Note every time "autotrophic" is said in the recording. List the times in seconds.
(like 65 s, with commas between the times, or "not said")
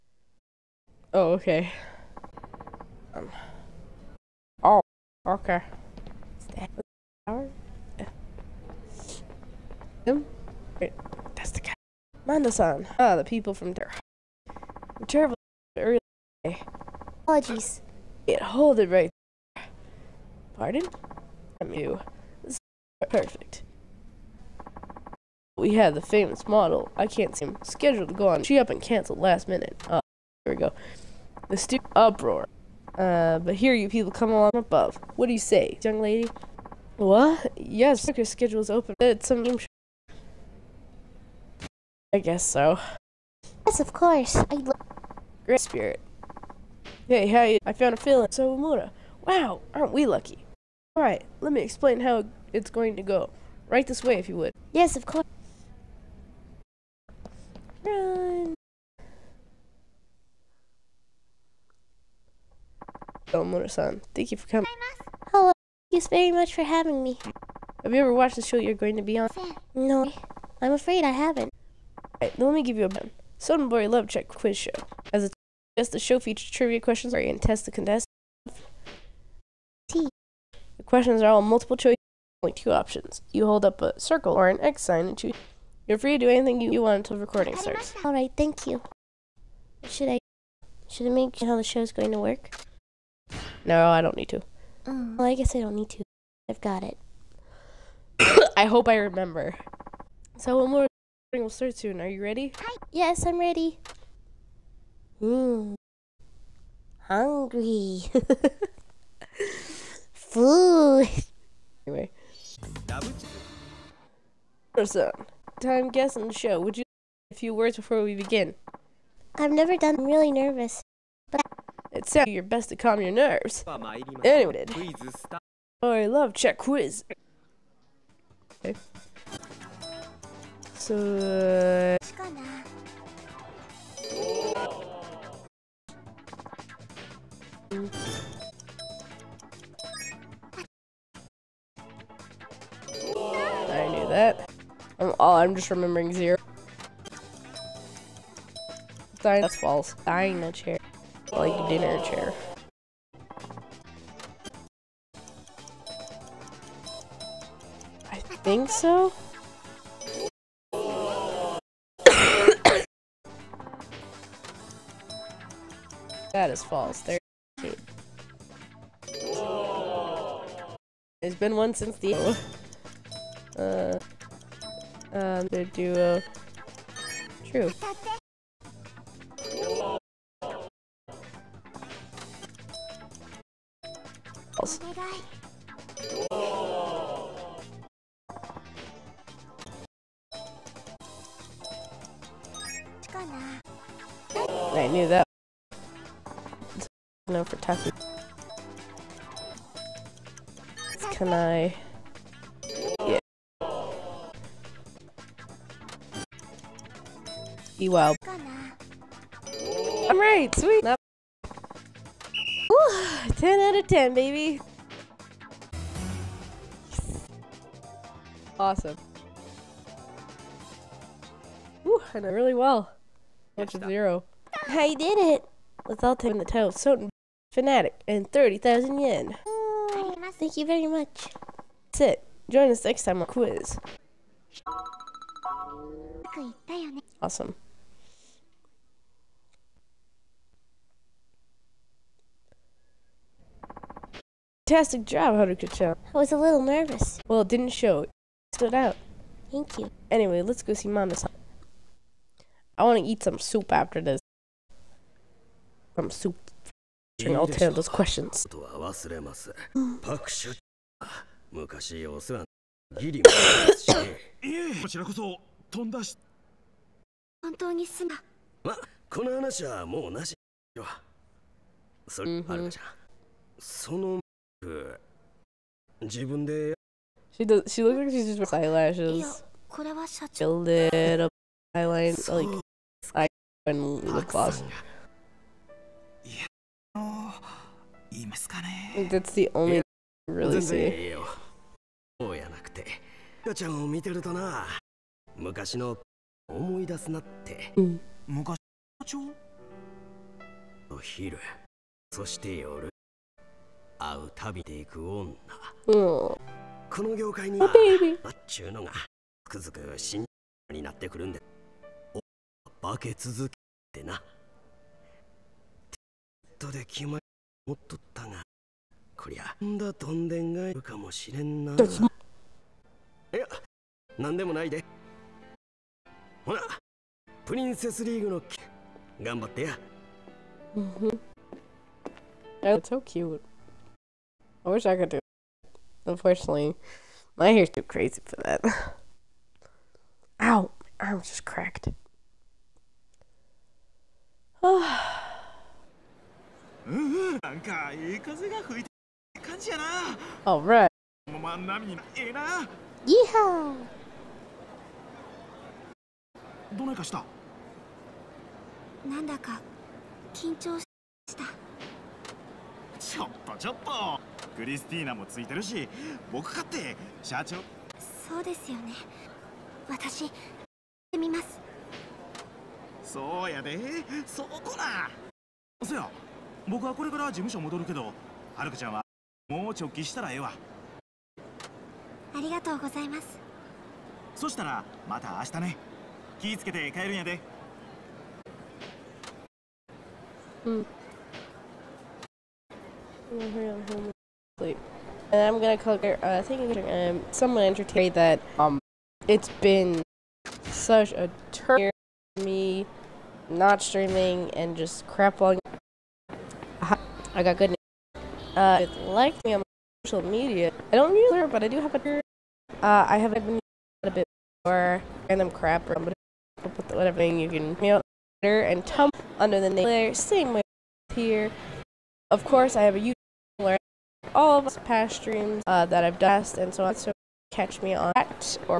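not said.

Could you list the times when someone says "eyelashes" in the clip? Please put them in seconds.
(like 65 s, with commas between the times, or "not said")
278 s.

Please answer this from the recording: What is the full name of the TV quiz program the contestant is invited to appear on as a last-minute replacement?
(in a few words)
Sudden Boy Love Check Quiz Show.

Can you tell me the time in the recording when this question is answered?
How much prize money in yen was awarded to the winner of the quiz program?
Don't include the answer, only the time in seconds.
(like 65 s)
228 s.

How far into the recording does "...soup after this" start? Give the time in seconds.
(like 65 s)
253 s.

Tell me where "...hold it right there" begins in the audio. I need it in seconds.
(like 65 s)
18 s.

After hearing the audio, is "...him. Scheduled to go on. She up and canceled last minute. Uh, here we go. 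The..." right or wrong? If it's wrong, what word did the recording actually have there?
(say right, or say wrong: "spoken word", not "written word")
right.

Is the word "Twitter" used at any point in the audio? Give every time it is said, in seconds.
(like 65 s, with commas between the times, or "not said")
411 s, 418 s.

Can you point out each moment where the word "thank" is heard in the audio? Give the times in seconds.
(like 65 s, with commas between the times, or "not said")
64 s, 88 s, 230 s, 249 s.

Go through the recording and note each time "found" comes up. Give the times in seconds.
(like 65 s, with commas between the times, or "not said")
47 s.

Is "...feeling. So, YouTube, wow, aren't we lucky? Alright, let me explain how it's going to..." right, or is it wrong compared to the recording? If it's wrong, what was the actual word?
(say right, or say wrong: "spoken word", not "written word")
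wrong: "Mura", not "YouTube".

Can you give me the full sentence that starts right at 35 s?
What do you say, young lady?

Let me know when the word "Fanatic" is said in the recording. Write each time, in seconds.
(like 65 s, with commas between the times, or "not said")
227 s.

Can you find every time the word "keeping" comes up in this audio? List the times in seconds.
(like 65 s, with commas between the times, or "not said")
not said.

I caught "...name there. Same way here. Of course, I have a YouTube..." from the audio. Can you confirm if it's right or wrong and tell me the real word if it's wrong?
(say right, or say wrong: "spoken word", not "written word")
right.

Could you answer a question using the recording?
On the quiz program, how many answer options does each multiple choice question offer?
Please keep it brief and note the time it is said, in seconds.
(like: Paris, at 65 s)
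2, at 82 s.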